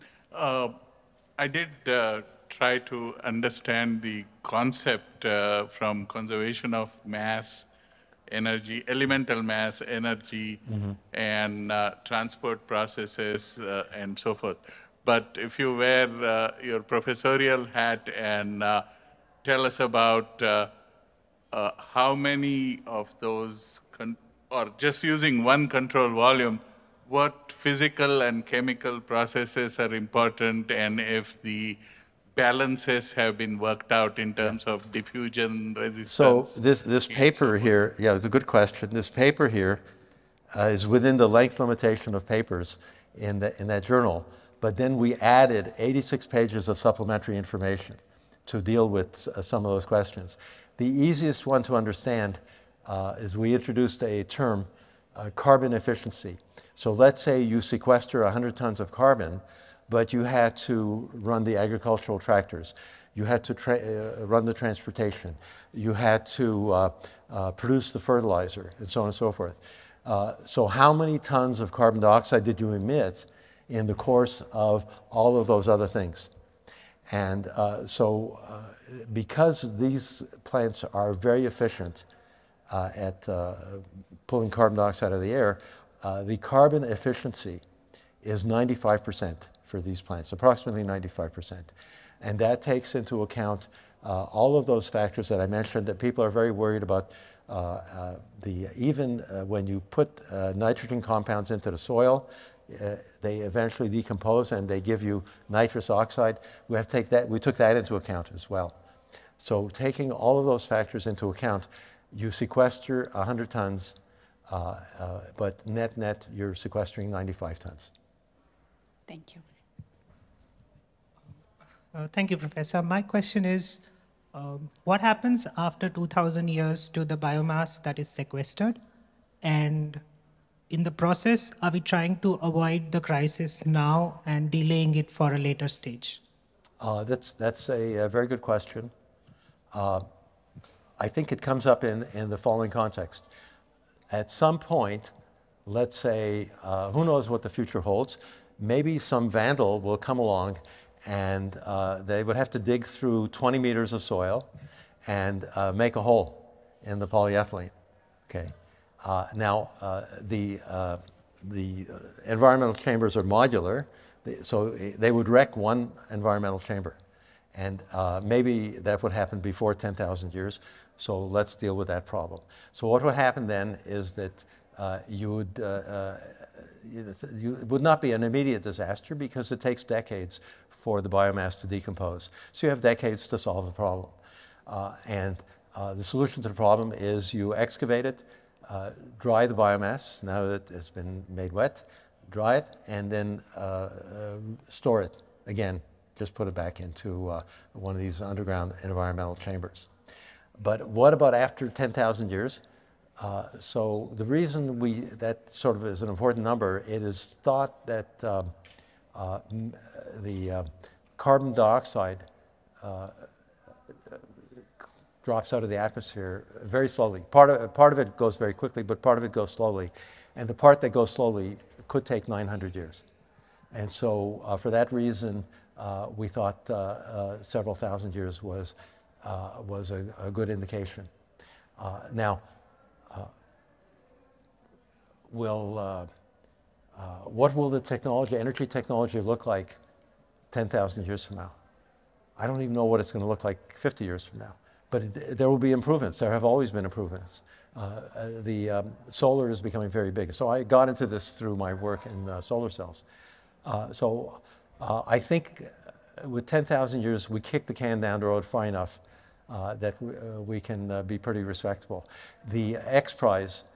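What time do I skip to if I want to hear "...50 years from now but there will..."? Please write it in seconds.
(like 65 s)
243 s.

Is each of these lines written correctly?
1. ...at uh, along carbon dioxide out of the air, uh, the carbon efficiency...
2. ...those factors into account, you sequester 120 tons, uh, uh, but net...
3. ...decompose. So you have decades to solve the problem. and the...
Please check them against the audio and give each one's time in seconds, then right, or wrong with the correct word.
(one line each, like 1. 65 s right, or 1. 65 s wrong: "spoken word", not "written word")
1. 82 s wrong: "pulling", not "along"
2. 110 s wrong: "100", not "120"
3. 181 s right.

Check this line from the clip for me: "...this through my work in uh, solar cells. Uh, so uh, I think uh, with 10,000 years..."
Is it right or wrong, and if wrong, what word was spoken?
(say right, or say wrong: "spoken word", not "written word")
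right.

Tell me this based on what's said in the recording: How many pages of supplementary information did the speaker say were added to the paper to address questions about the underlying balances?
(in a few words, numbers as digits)
86.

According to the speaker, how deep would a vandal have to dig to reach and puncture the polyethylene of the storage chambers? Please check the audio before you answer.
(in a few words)
20 meters.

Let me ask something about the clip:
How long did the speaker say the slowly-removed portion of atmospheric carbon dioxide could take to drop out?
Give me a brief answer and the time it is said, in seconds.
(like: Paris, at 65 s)
900 years, at 222 s.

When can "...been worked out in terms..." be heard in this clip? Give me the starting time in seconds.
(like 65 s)
33 s.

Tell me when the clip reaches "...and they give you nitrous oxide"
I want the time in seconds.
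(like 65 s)
104 s.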